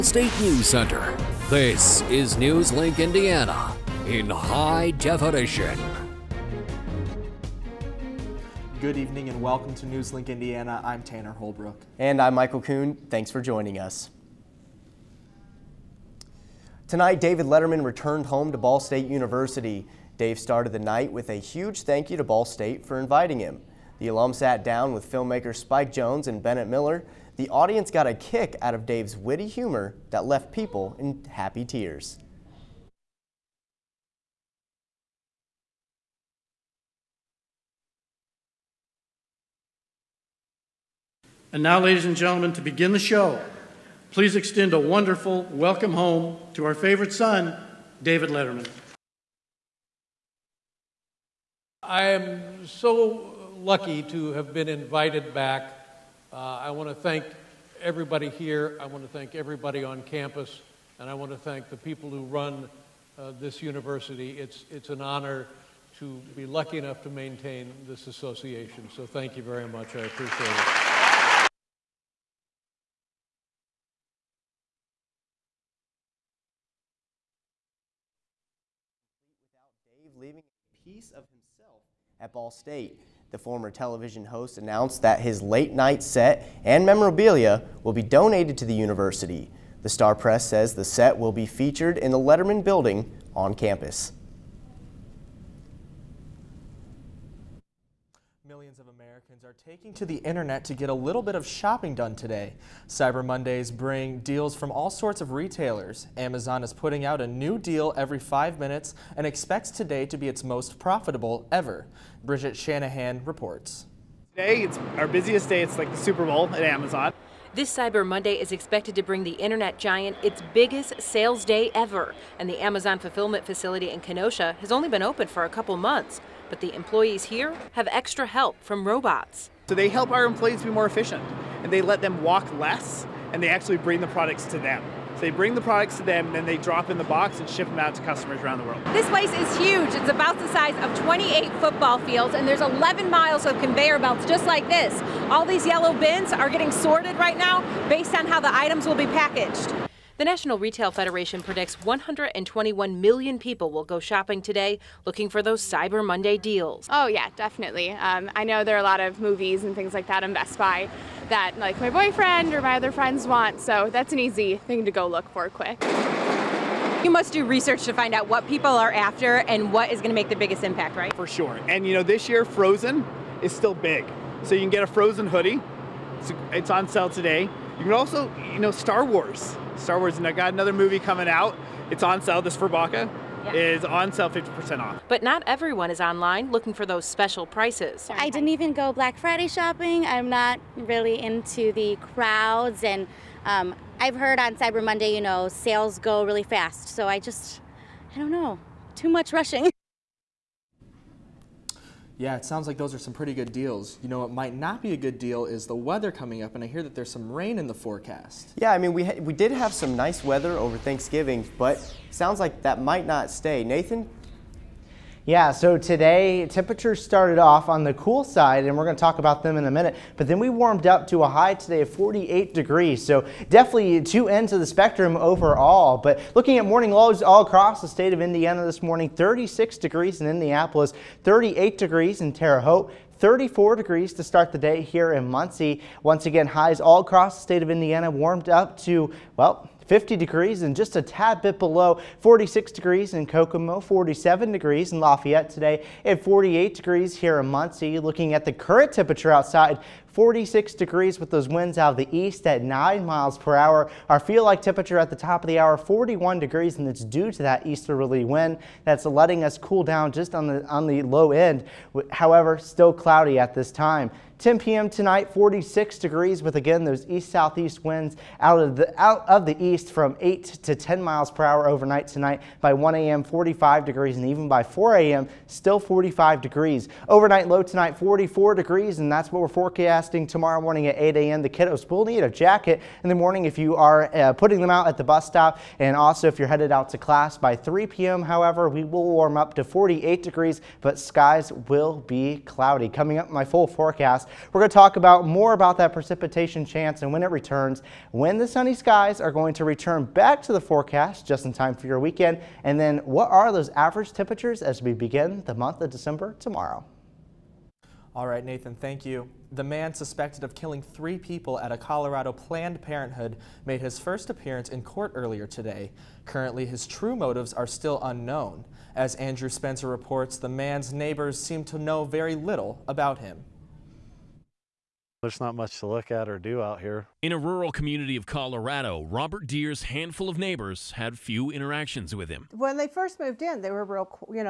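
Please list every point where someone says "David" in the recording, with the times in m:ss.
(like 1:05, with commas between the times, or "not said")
0:17, 0:48.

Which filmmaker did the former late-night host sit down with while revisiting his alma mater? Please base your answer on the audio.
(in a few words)
Spike Jonze.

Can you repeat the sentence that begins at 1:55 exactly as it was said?
It's like the Super Bowl at Amazon.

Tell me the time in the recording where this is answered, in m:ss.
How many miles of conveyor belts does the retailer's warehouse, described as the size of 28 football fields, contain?
2:22.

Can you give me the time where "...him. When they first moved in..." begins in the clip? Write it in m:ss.
5:32.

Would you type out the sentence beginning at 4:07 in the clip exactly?
Looking at the current temperature outside, 46 degrees with those winds out of the east at 9 miles per hour.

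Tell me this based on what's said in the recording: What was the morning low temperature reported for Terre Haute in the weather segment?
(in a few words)
38 degrees.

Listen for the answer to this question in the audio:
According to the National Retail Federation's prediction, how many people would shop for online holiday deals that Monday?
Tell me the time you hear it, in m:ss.
2:31.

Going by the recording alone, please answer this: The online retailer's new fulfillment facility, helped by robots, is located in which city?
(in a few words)
Kenosha.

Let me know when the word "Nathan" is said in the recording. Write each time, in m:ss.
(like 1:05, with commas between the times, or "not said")
3:33, 5:08.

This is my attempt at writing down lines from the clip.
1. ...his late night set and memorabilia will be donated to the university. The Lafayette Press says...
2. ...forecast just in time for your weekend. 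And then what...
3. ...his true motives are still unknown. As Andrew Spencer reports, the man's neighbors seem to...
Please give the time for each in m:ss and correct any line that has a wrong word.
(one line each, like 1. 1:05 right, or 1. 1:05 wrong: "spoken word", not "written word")
1. 1:25 wrong: "Star", not "Lafayette"
2. 5:00 right
3. 5:16 right.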